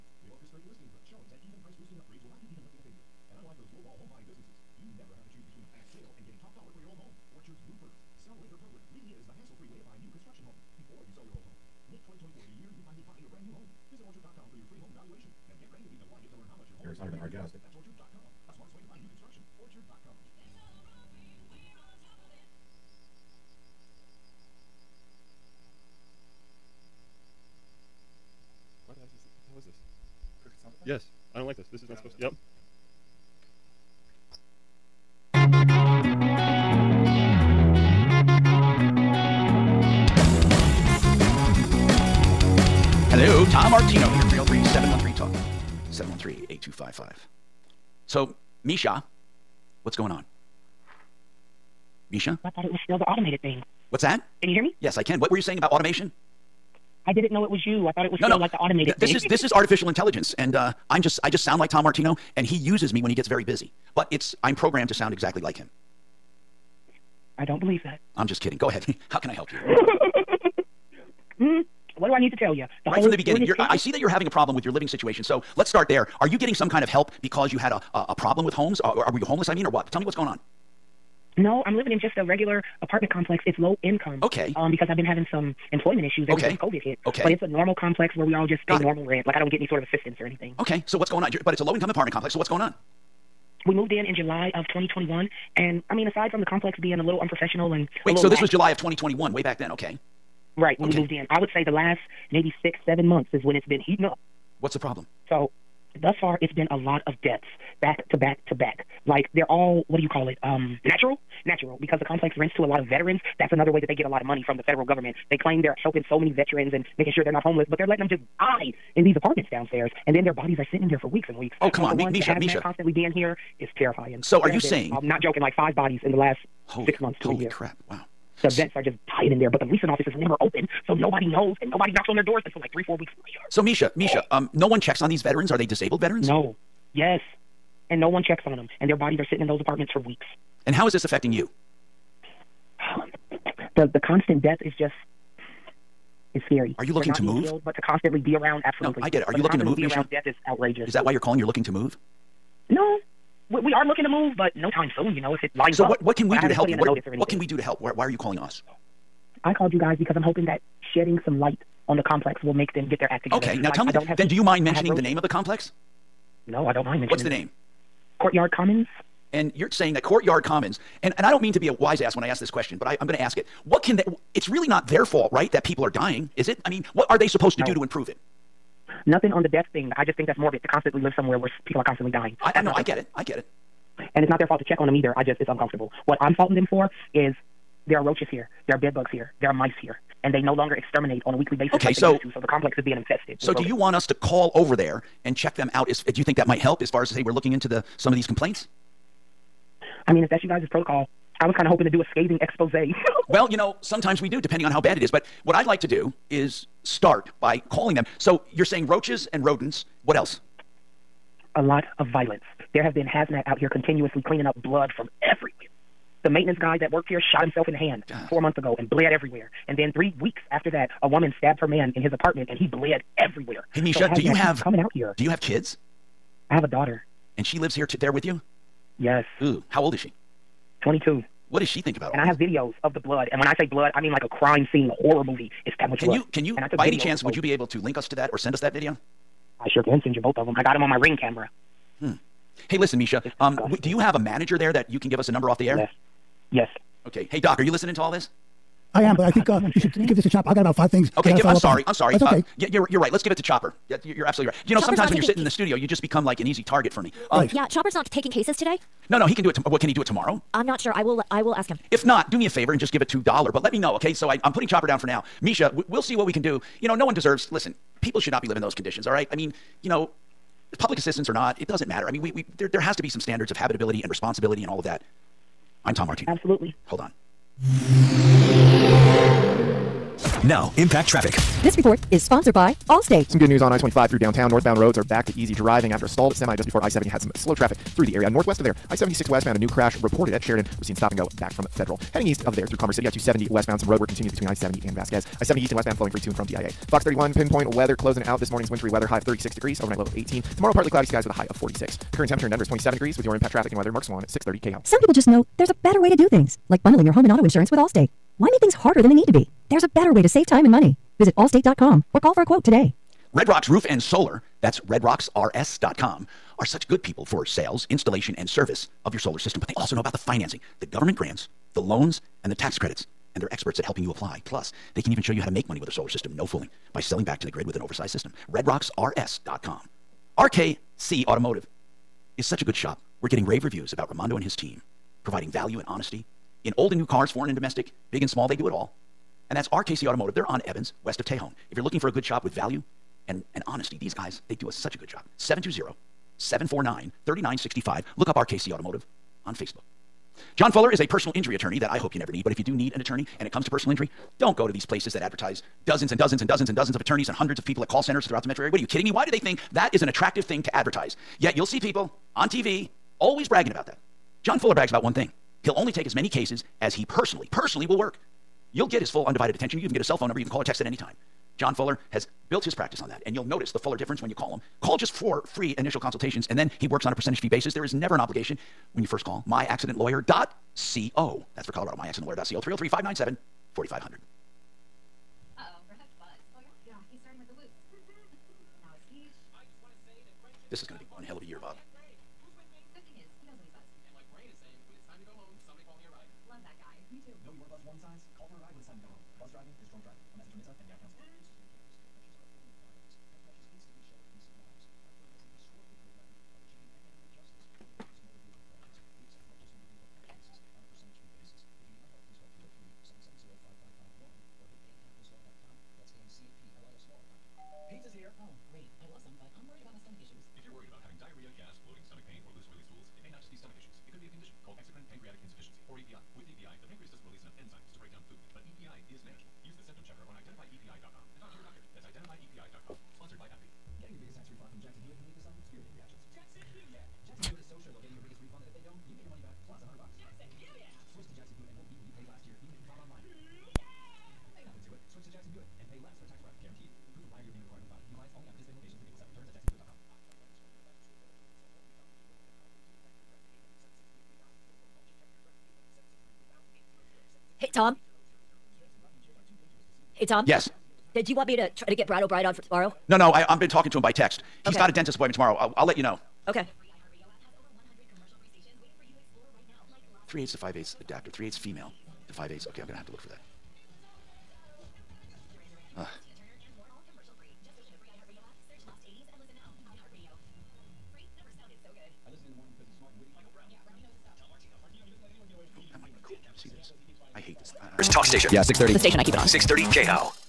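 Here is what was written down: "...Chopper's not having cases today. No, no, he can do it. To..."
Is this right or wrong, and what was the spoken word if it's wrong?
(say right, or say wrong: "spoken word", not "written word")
wrong: "taking", not "having".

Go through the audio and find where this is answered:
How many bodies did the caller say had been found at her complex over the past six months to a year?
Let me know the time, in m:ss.
2:05.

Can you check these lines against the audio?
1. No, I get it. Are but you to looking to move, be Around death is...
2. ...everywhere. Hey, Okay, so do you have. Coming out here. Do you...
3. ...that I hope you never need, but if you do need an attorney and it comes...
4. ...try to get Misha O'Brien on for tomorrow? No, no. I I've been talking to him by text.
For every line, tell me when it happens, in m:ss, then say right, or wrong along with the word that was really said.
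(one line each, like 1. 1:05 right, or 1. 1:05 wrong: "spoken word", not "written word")
1. 2:29 right
2. 3:43 wrong: "Misha", not "Okay"
3. 5:51 right
4. 7:41 wrong: "Brad", not "Misha".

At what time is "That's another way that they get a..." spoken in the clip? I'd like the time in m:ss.
1:53.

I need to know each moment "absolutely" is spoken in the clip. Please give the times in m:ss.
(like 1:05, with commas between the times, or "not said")
2:28, 4:14, 4:36.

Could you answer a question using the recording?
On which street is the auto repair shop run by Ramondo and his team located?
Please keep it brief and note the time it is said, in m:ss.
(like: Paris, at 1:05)
Evans, at 5:40.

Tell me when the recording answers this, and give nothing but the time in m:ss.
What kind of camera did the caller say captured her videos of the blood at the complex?
4:00.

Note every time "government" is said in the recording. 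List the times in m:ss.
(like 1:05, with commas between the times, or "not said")
1:54, 5:20.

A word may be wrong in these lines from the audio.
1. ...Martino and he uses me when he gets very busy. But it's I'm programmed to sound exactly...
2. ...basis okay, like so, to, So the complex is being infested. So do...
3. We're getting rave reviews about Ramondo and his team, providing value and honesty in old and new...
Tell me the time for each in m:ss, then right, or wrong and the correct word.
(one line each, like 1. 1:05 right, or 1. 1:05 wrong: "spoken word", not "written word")
1. 1:01 right
2. 3:11 right
3. 5:33 right.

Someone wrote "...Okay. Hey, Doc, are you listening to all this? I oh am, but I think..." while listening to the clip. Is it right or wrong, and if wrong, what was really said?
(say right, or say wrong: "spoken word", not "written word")
right.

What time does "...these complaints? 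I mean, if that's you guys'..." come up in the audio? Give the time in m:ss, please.
3:18.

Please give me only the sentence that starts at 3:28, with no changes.
So you're saying roaches and rodents.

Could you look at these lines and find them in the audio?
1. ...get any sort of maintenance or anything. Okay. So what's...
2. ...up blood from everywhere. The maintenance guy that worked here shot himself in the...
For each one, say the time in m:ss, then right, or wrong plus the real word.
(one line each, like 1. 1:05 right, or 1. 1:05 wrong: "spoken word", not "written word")
1. 1:29 wrong: "assistance", not "maintenance"
2. 3:34 right.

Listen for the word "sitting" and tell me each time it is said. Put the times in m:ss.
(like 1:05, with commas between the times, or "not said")
2:00, 2:19, 4:15.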